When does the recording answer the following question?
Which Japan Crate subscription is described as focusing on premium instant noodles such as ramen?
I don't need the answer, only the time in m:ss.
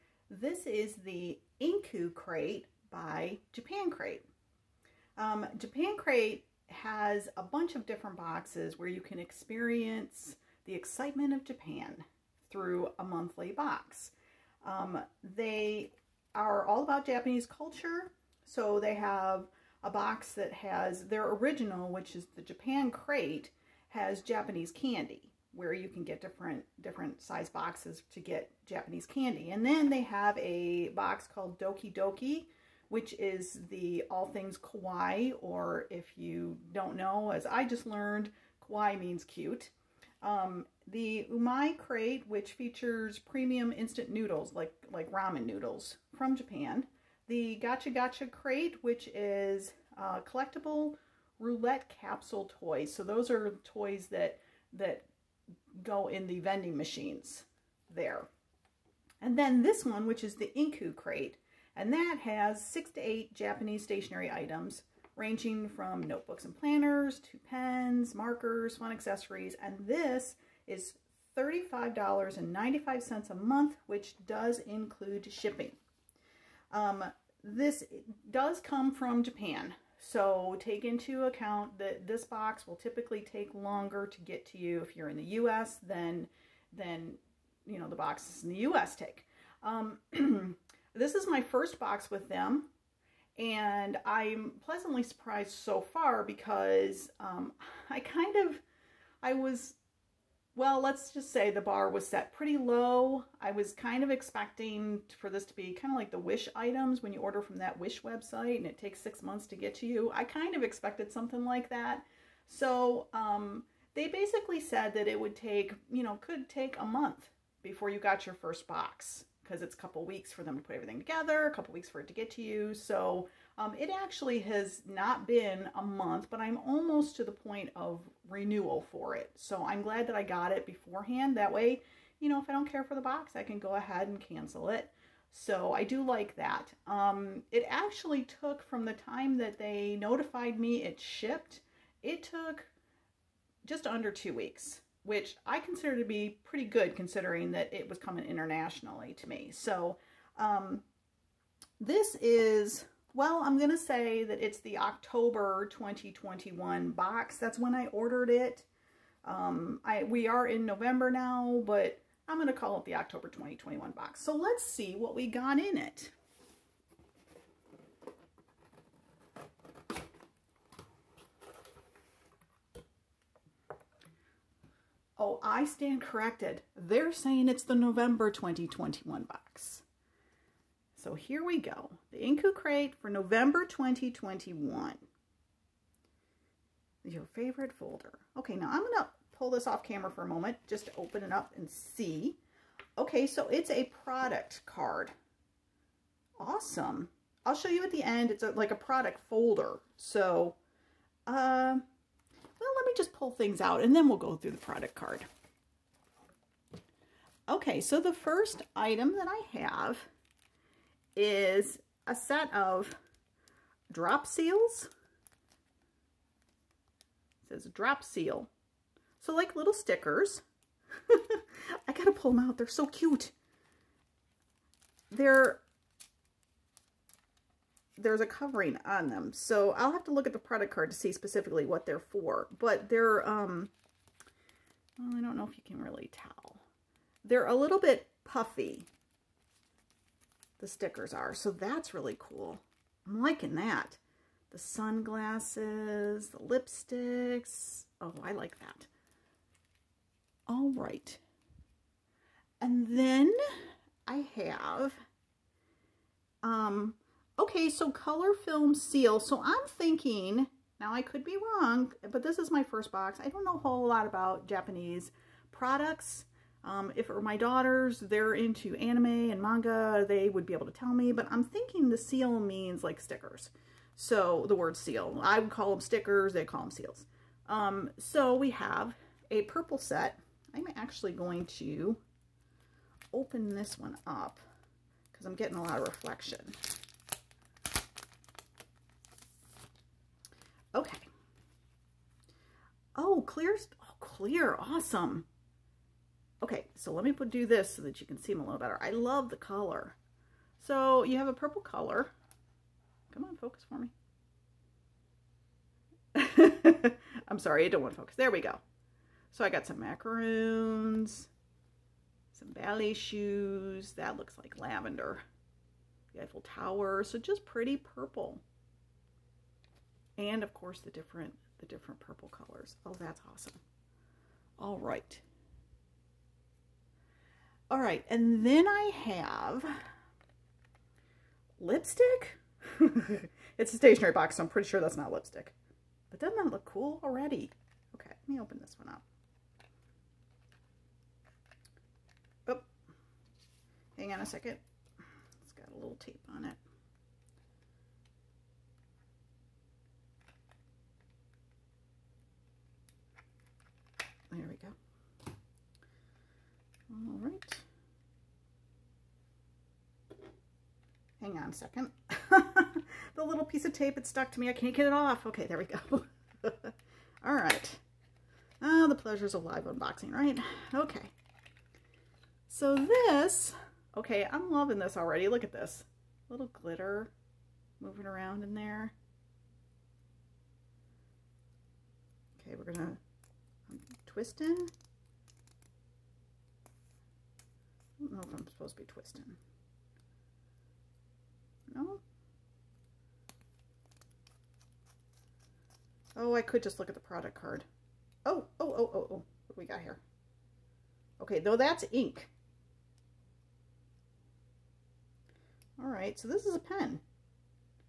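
0:41.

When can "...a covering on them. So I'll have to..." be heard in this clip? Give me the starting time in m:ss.
3:48.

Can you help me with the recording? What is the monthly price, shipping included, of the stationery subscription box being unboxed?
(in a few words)
$35.95.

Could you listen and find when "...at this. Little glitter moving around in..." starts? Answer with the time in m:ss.
6:15.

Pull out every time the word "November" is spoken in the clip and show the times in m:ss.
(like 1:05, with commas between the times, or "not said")
2:40, 2:57, 3:03.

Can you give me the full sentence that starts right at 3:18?
It's a, like a product folder.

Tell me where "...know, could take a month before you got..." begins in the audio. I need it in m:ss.
1:56.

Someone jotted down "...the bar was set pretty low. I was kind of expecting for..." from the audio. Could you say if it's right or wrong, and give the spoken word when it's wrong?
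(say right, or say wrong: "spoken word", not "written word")
right.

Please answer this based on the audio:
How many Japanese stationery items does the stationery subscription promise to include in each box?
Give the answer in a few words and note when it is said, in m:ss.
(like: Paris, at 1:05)
6 to 8, at 1:02.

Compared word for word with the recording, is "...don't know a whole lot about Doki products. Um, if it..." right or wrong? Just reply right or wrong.
wrong.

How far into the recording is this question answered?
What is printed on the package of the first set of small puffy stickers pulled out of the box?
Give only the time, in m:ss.
3:37.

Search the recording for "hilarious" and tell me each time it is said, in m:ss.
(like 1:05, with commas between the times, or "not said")
not said.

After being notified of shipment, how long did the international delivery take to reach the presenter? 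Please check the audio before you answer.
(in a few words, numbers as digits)
just under 2 weeks.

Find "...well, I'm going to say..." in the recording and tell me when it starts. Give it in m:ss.
2:33.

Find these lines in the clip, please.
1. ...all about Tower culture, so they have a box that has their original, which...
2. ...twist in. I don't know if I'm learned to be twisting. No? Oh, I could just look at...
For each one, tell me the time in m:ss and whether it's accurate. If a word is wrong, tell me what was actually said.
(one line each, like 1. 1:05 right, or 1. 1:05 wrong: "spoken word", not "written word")
1. 0:16 wrong: "Japanese", not "Tower"
2. 6:24 wrong: "supposed", not "learned".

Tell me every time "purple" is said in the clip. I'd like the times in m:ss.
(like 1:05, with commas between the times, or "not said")
4:39, 5:01, 5:17, 5:21.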